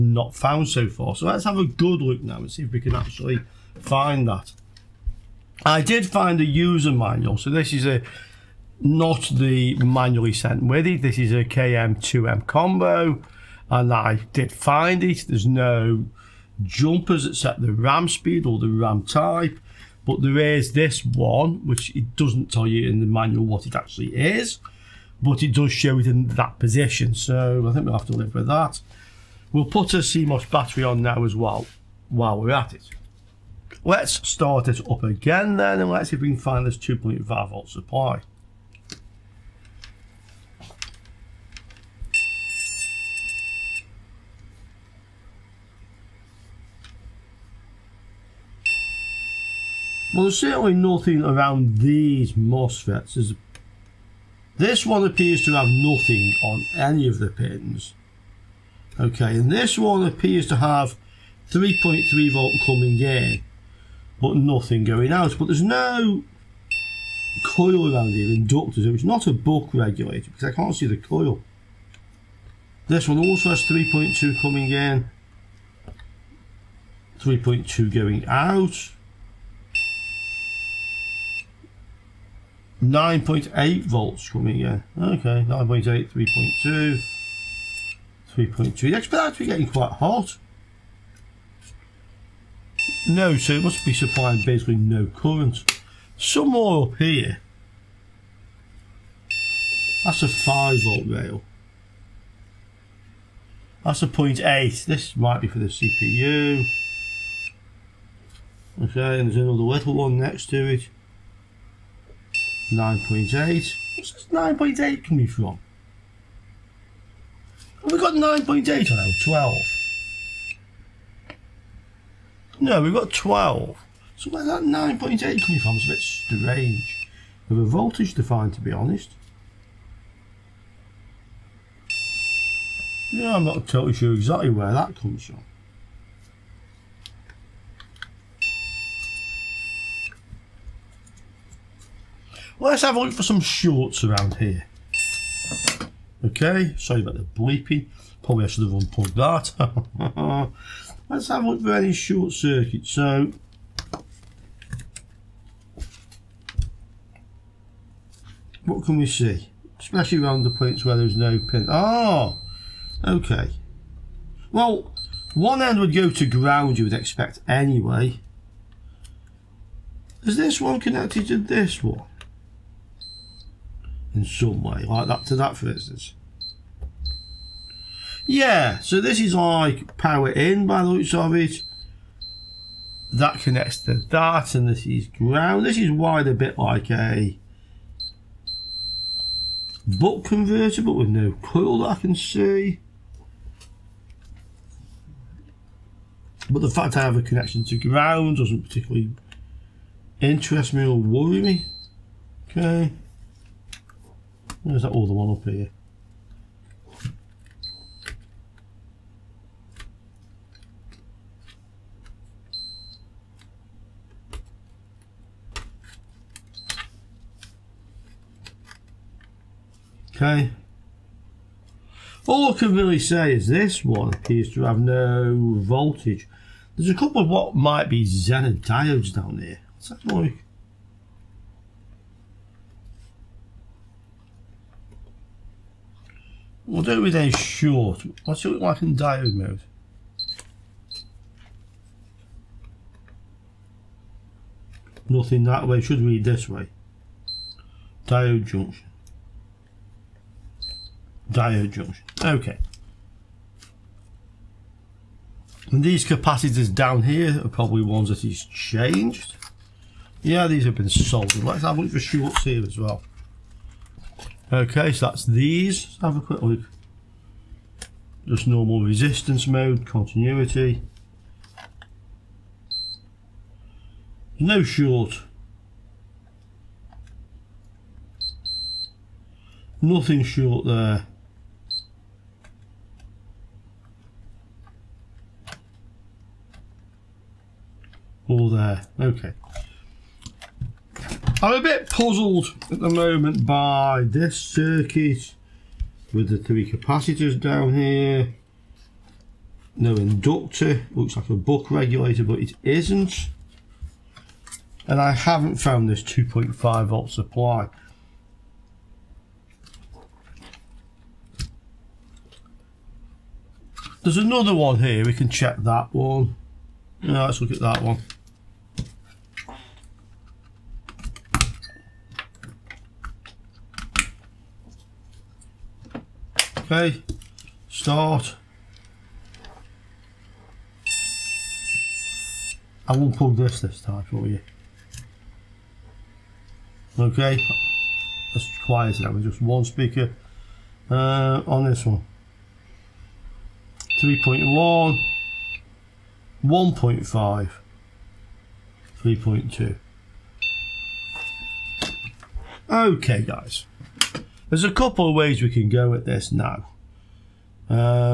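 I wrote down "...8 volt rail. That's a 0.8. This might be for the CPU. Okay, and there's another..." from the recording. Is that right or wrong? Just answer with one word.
wrong.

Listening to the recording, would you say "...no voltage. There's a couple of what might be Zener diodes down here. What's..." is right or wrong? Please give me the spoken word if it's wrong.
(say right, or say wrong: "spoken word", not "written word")
right.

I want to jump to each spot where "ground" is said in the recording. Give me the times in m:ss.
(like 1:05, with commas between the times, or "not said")
2:46, 3:05, 3:17.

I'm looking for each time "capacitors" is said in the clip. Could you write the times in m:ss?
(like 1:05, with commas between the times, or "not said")
4:16, 4:56.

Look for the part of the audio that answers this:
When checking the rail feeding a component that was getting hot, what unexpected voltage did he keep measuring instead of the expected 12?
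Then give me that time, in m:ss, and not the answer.
1:22.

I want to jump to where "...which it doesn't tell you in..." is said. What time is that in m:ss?
0:21.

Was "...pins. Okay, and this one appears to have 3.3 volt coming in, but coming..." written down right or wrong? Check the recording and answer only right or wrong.
wrong.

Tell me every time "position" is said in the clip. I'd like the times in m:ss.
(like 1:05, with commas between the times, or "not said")
0:26.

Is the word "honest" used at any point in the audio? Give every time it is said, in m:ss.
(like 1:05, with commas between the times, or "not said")
2:08.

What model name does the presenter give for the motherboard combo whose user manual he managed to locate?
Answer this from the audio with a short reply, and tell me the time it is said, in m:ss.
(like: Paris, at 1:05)
KM2M, at 0:11.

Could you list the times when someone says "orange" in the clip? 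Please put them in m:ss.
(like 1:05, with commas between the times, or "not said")
not said.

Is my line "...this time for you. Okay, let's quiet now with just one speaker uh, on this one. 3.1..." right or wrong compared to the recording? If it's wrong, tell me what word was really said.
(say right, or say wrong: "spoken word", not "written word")
right.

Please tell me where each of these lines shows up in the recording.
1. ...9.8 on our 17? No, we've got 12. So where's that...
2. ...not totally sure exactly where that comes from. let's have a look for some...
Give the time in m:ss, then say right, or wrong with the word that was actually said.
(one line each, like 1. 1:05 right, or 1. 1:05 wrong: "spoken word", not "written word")
1. 1:58 wrong: "12", not "17"
2. 2:13 right.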